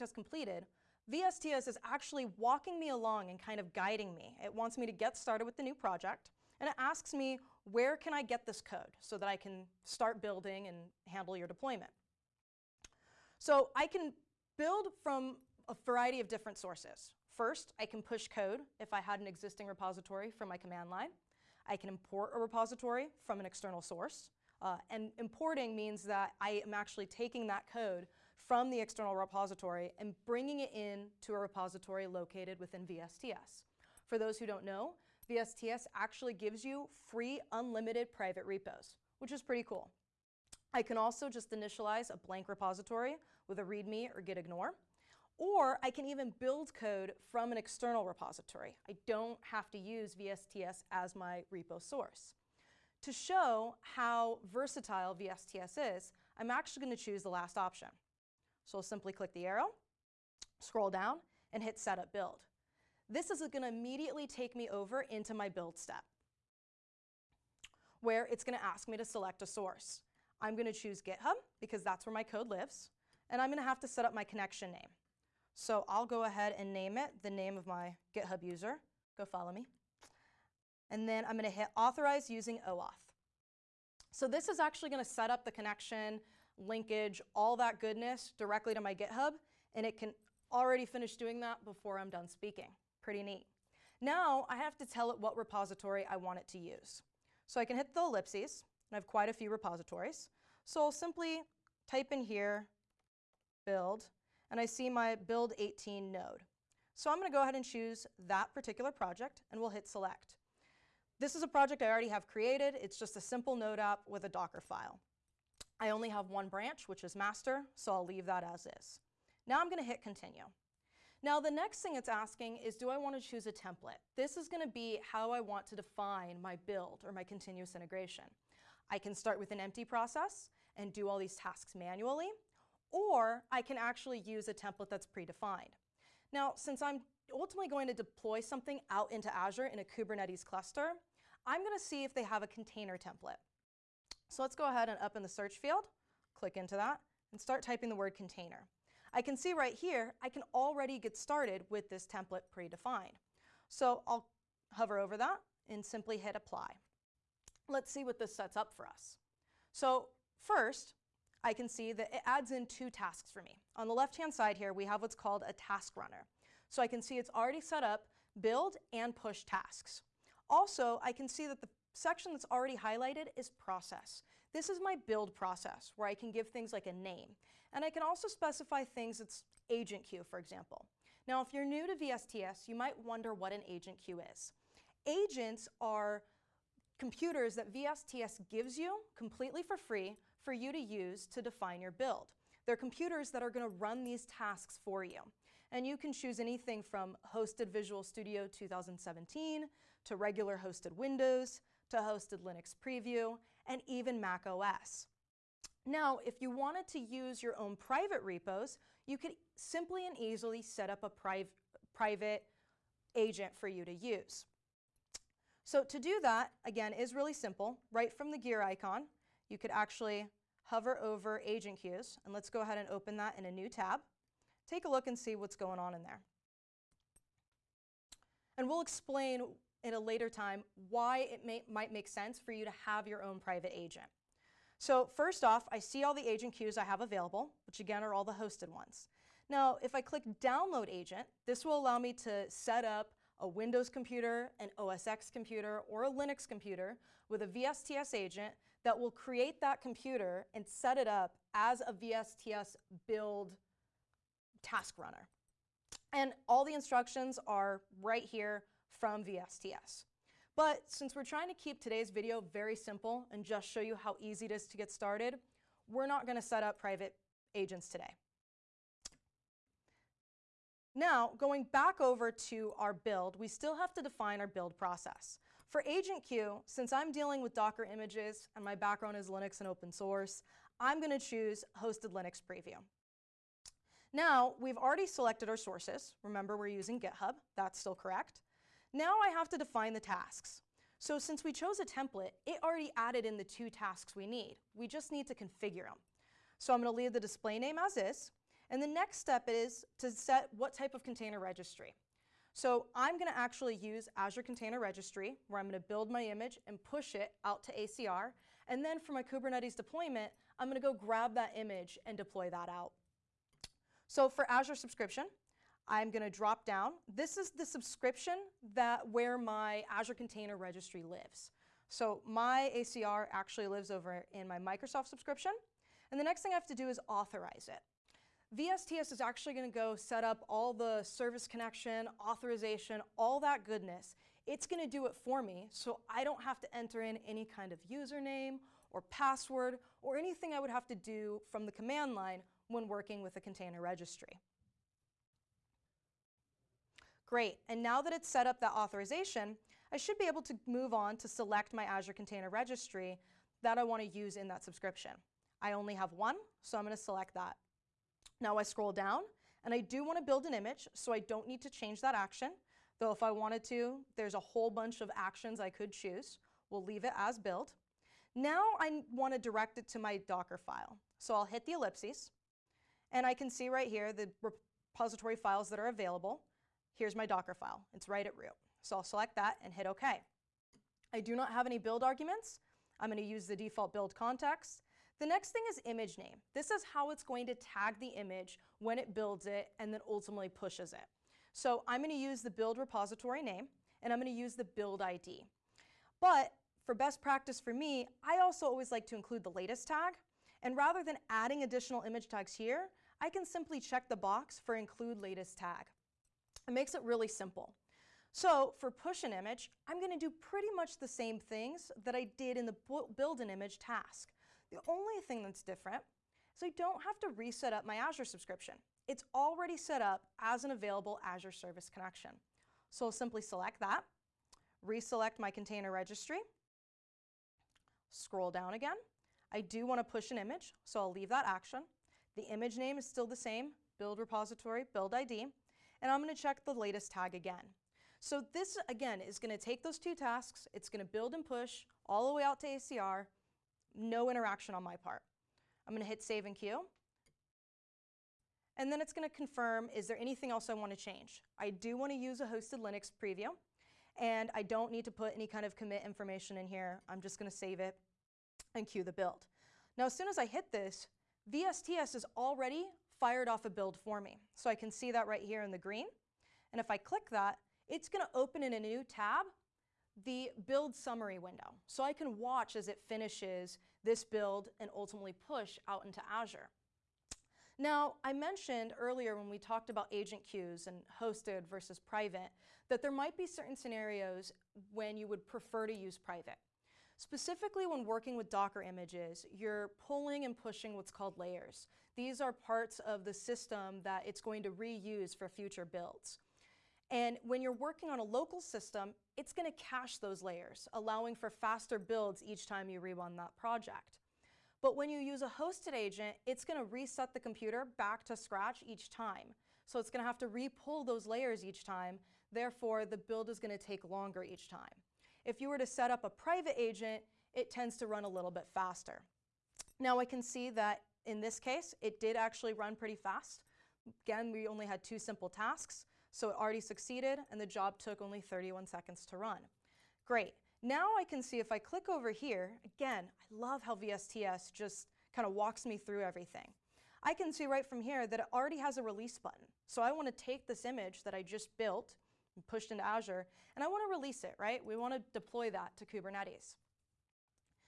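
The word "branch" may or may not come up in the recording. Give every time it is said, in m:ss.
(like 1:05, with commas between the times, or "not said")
1:56.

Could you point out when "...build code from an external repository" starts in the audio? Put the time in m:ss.
0:46.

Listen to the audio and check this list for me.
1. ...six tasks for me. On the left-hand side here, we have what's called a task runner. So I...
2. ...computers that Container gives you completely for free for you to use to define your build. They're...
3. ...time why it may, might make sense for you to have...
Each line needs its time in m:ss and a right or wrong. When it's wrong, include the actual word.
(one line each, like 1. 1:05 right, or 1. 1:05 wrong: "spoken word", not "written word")
1. 2:42 wrong: "two", not "six"
2. 3:06 wrong: "VSTS", not "Container"
3. 3:50 right.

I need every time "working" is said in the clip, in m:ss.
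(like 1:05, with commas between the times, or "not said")
5:42, 8:08, 8:17.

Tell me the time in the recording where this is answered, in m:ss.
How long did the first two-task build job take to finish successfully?
8:48.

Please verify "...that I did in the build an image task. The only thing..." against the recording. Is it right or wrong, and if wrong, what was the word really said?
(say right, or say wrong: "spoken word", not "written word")
right.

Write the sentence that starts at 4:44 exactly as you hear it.
Now, we've already selected our sources.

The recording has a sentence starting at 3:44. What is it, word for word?
Take a look and see what's going on in there.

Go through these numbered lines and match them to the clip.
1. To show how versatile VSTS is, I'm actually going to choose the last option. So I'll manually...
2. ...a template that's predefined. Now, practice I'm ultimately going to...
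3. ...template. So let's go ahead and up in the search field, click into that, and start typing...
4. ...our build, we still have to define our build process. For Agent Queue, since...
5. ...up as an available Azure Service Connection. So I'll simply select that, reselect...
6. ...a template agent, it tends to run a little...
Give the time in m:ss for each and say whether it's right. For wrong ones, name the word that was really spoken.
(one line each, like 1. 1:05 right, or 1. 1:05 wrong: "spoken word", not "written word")
1. 0:53 wrong: "simply", not "manually"
2. 2:14 wrong: "since", not "practice"
3. 2:22 right
4. 4:32 right
5. 7:00 right
6. 8:36 wrong: "private", not "template".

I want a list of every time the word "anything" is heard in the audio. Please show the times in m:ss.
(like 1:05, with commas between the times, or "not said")
3:16, 5:40, 7:30.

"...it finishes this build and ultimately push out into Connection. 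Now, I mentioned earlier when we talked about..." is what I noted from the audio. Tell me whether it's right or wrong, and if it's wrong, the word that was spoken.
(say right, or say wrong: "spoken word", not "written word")
wrong: "Azure", not "Connection".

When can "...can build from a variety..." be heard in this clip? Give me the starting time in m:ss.
0:13.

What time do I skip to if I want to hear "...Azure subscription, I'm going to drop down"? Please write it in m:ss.
5:14.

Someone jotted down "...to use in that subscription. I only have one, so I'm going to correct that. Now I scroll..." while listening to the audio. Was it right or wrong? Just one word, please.
wrong.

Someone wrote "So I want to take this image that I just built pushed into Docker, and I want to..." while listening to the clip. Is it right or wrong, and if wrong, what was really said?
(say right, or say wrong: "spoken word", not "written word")
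wrong: "Azure", not "Docker".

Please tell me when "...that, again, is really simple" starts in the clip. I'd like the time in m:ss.
3:36.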